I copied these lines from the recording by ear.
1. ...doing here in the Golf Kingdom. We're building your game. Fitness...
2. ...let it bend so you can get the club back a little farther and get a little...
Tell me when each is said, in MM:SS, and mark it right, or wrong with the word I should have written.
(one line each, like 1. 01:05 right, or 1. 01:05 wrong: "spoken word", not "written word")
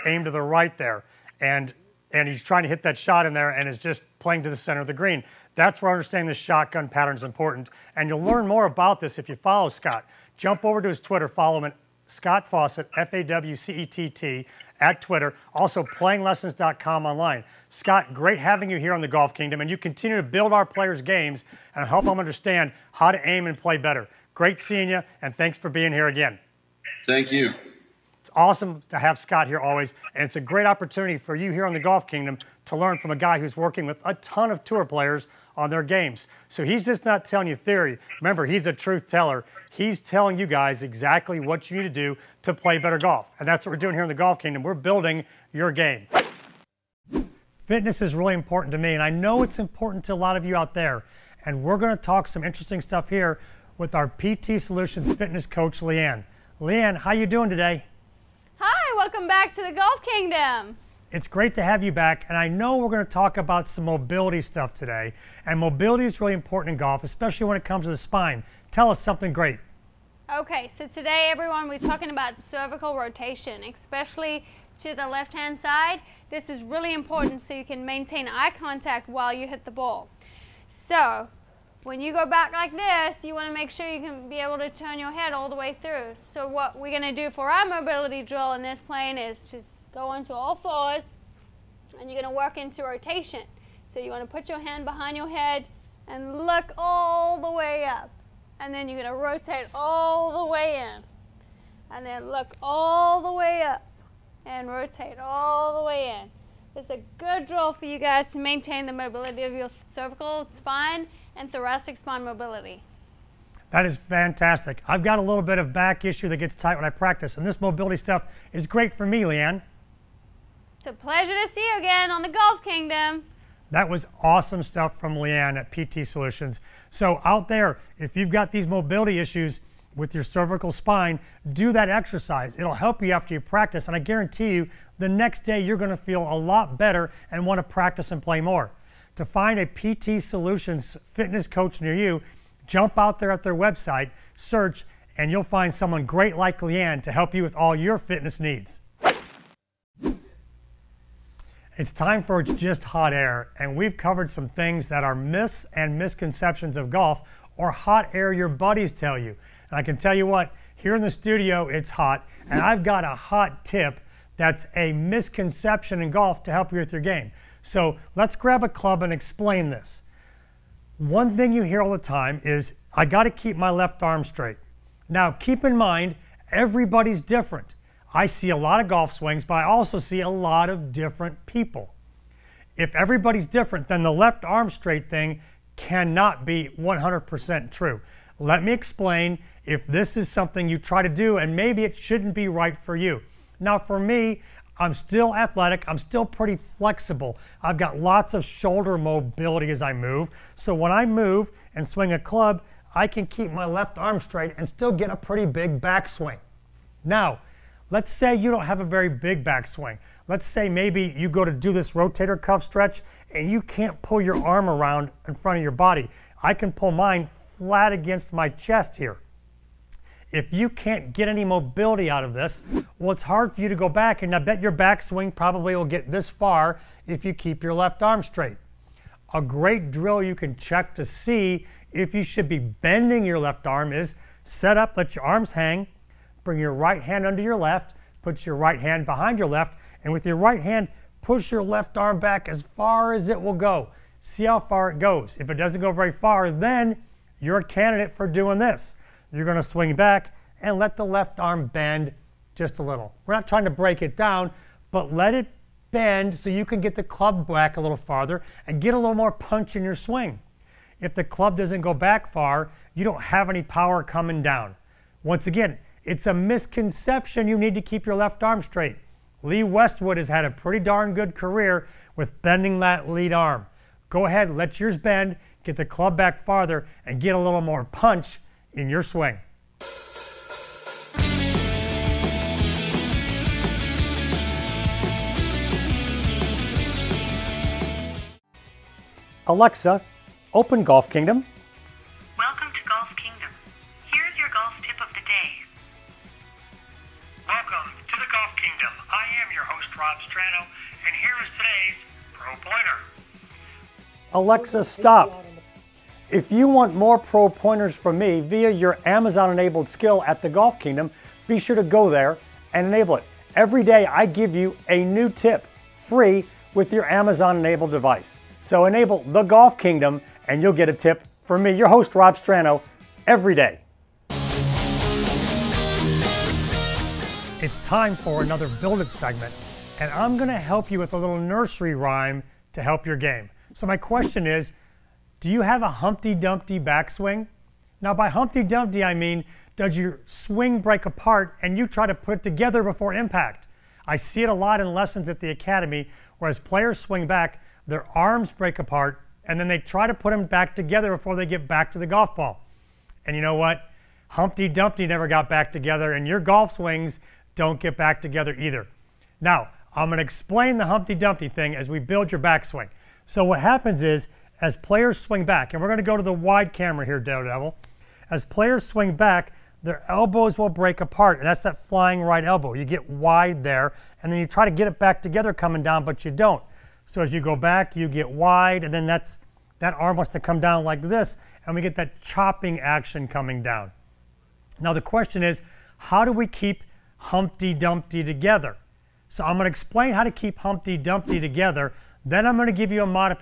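1. 00:43 right
2. 04:15 right.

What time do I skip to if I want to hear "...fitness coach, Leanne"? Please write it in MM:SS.
00:55.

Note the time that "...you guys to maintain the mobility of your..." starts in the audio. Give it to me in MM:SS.
01:47.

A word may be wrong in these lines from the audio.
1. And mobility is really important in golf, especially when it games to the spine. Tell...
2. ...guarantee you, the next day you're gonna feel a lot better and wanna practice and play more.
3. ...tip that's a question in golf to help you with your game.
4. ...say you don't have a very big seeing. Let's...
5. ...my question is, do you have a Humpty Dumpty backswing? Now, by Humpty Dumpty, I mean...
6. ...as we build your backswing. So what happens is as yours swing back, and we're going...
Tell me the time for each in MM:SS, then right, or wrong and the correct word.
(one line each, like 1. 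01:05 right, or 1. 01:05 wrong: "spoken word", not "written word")
1. 01:05 wrong: "comes", not "games"
2. 02:13 right
3. 02:43 wrong: "misconception", not "question"
4. 03:28 wrong: "backswing", not "seeing"
5. 05:33 right
6. 06:01 wrong: "players", not "yours".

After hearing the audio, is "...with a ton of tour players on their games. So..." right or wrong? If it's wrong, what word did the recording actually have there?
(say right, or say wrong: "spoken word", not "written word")
right.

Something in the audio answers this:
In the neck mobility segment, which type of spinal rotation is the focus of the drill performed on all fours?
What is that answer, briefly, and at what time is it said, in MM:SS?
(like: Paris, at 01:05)
Cervical rotation, at 01:12.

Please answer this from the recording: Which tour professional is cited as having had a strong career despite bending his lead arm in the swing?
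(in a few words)
Lee Westwood.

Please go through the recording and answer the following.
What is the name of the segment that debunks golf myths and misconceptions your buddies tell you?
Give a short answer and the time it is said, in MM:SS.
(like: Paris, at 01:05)
It's Just Hot Air, at 02:32.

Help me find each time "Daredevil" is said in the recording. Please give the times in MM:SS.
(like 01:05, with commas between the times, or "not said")
06:07.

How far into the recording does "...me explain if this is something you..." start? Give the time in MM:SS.
03:08.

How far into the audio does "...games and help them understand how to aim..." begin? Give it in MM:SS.
00:21.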